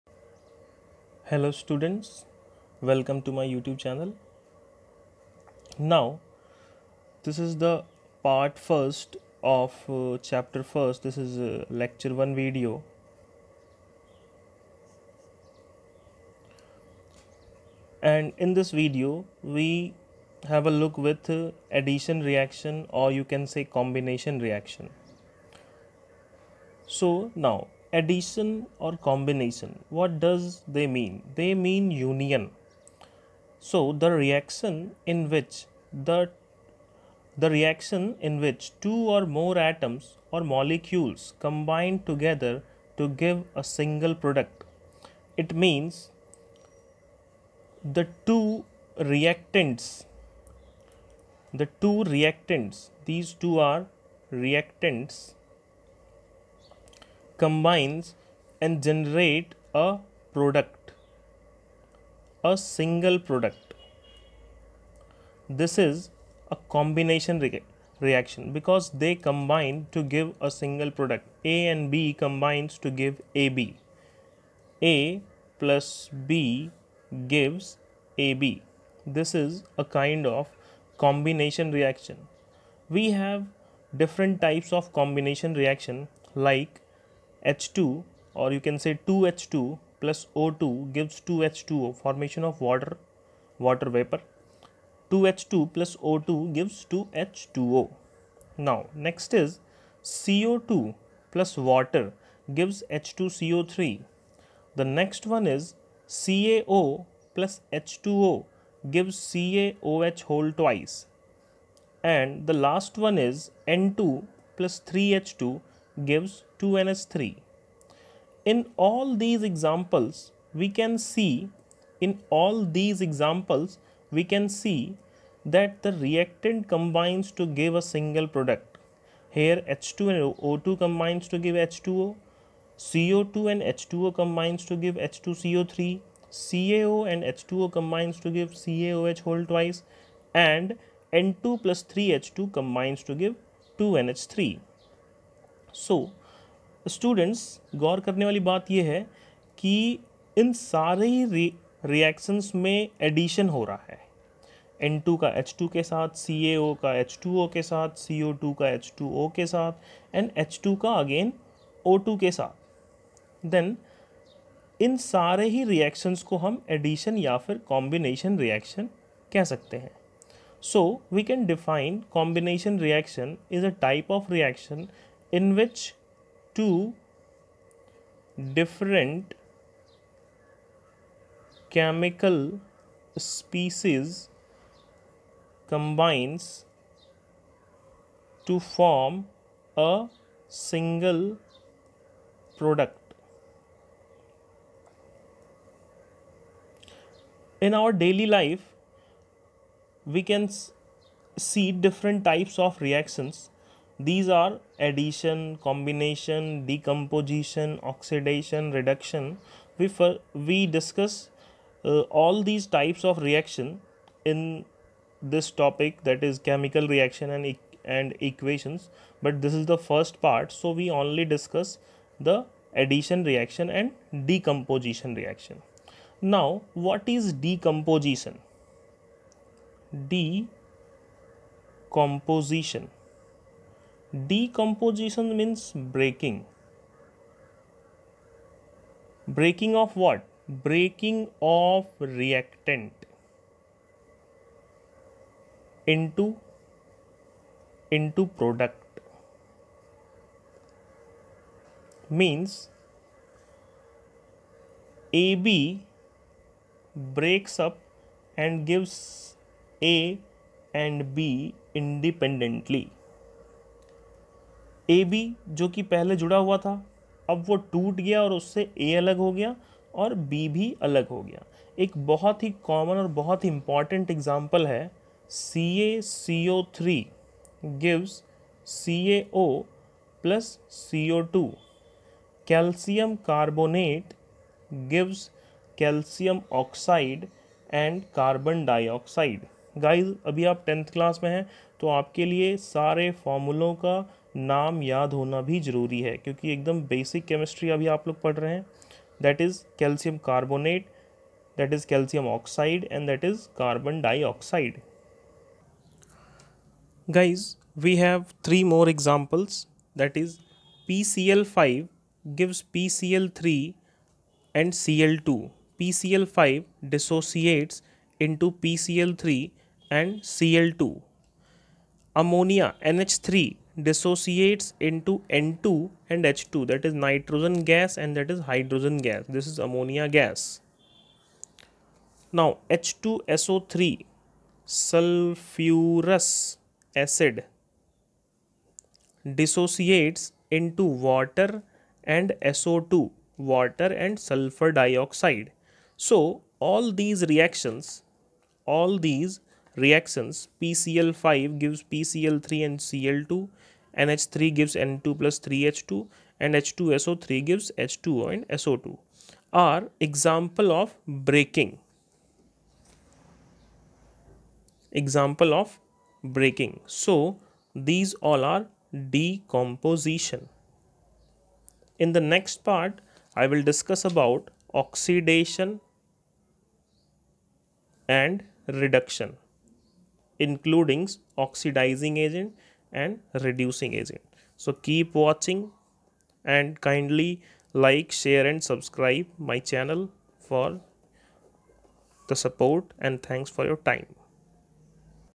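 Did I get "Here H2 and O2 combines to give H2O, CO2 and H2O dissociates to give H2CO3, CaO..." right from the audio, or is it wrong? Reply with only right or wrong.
wrong.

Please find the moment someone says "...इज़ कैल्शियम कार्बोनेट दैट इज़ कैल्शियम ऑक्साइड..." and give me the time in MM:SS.
04:59.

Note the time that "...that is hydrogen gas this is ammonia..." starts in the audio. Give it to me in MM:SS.
05:28.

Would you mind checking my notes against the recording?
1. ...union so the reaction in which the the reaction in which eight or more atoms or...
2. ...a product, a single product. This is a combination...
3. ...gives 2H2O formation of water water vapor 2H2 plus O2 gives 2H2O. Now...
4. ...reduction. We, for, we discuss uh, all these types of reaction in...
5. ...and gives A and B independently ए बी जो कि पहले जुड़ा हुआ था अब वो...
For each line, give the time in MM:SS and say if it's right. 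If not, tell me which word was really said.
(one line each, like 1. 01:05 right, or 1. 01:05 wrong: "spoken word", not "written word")
1. 00:31 wrong: "two", not "eight"
2. 00:59 right
3. 01:30 right
4. 03:28 right
5. 04:18 right.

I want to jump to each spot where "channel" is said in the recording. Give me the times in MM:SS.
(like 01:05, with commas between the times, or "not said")
00:03, 06:29.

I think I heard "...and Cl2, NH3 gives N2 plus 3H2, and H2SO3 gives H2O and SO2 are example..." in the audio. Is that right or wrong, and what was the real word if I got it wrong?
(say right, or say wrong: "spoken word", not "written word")
right.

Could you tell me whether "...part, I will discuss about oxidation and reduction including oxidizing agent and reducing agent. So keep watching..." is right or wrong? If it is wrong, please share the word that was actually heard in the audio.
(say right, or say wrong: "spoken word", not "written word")
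right.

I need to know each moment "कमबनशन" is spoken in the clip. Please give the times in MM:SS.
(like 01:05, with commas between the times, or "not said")
02:47, 02:52.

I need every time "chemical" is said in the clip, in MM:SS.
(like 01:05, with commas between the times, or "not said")
03:01, 03:36.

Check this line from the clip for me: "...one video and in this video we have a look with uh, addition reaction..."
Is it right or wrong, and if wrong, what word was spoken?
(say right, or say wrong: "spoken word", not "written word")
right.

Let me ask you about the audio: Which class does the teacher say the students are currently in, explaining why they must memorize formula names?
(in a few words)
10th.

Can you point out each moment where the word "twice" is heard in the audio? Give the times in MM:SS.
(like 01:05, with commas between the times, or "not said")
01:50, 02:19.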